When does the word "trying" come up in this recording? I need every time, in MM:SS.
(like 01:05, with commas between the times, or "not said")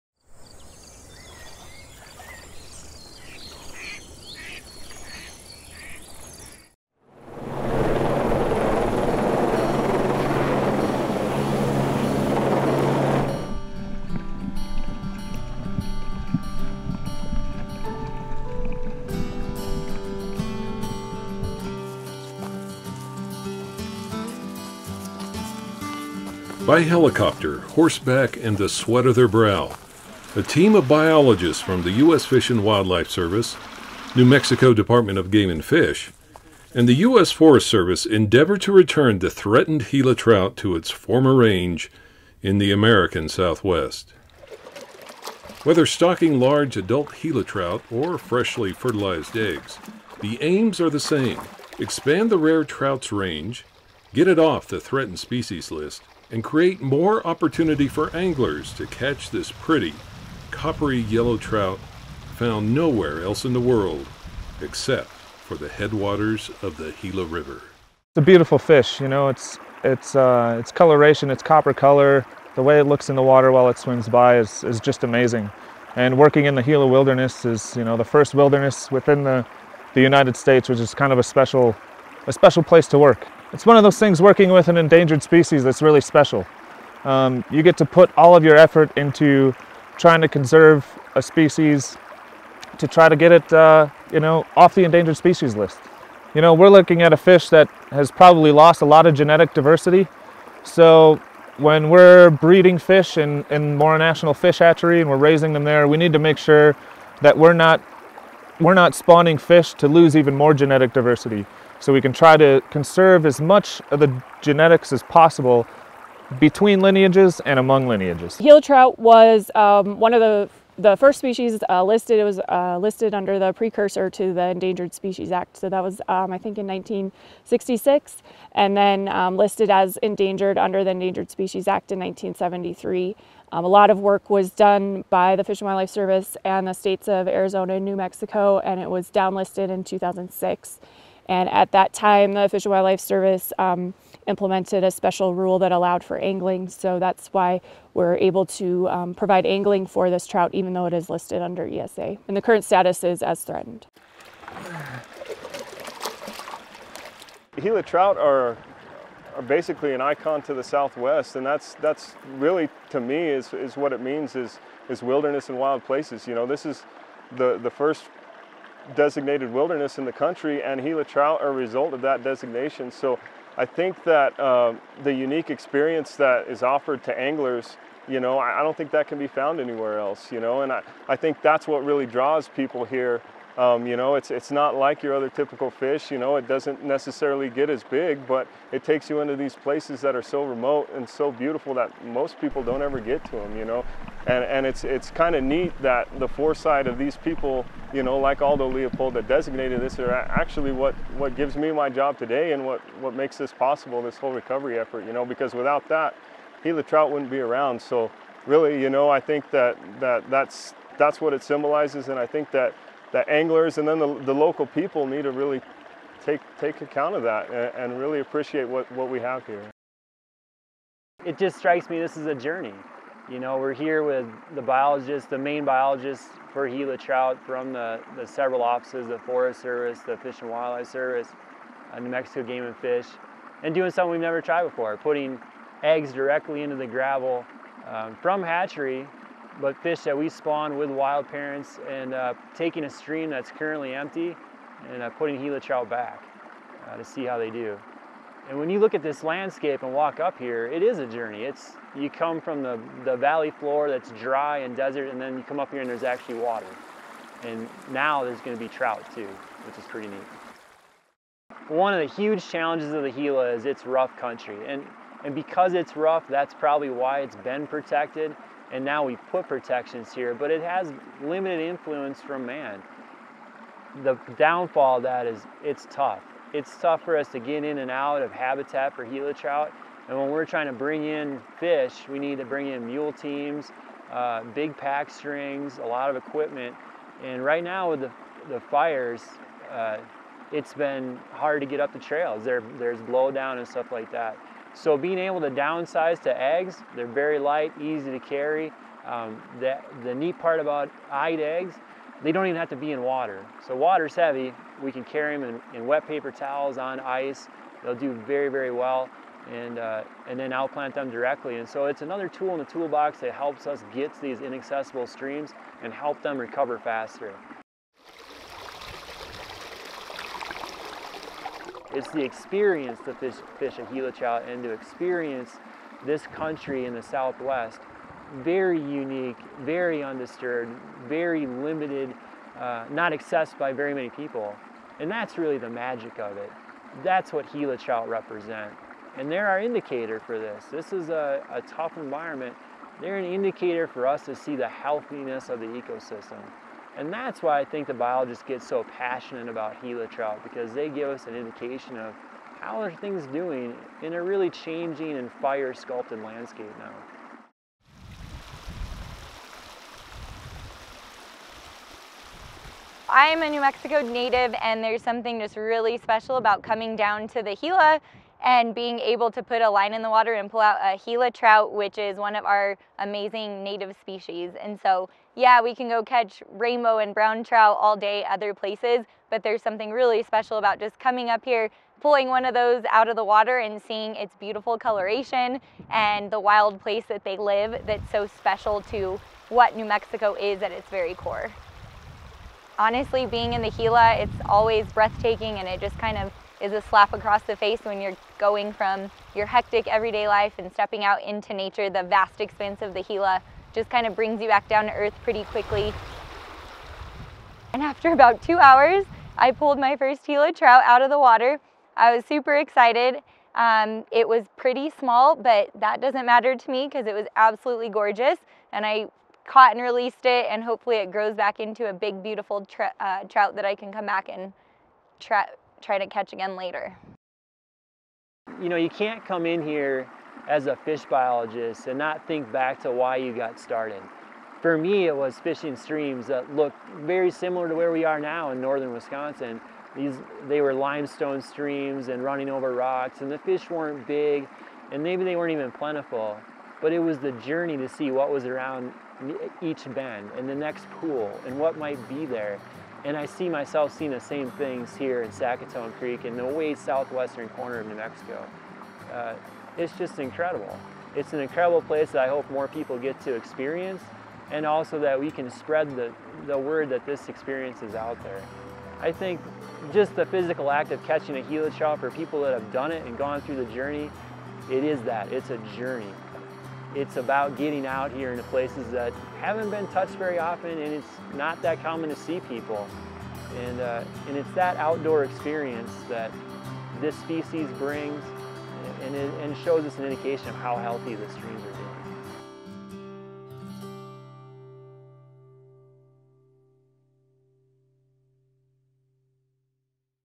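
01:29, 04:40.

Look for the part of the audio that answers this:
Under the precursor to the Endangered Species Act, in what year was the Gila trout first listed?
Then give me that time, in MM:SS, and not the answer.
02:06.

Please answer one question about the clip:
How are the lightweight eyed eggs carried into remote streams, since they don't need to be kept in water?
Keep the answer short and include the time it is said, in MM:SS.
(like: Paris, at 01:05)
wet paper towels on ice, at 05:05.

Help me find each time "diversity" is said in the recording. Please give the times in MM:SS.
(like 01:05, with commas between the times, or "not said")
01:39, 01:50.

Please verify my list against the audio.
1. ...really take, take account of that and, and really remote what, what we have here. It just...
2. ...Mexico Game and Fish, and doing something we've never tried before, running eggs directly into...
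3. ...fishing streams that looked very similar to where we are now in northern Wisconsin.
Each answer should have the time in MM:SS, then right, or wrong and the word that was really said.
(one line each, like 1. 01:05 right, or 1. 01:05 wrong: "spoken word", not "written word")
1. 03:35 wrong: "appreciate", not "remote"
2. 03:52 wrong: "putting", not "running"
3. 07:15 right.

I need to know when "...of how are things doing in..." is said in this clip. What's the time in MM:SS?
05:51.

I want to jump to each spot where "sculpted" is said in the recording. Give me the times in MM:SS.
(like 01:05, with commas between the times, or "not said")
05:55.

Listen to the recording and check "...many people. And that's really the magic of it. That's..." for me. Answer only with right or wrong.
right.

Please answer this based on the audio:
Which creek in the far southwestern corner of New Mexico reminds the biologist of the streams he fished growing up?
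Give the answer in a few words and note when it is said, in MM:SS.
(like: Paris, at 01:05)
Sacaton Creek, at 07:35.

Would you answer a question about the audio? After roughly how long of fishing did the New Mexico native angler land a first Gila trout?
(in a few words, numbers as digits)
2 hours.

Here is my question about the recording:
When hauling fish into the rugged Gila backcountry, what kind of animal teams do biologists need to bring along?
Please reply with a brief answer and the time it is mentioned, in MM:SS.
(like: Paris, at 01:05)
mule teams, at 04:42.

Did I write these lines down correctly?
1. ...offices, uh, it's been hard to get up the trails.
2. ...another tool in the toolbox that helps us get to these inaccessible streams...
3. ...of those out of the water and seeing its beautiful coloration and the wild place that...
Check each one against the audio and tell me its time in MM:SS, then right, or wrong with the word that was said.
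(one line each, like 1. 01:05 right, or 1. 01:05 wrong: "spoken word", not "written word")
1. 04:48 wrong: "fires", not "offices"
2. 05:12 right
3. 06:22 right.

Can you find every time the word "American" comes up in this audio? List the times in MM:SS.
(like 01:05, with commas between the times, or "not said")
00:42.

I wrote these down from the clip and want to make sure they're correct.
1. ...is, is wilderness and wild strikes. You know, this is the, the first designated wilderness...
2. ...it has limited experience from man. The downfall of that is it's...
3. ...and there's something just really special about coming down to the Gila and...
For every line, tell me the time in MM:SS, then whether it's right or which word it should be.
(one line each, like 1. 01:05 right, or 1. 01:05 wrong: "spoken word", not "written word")
1. 02:44 wrong: "places", not "strikes"
2. 04:30 wrong: "influence", not "experience"
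3. 06:04 right.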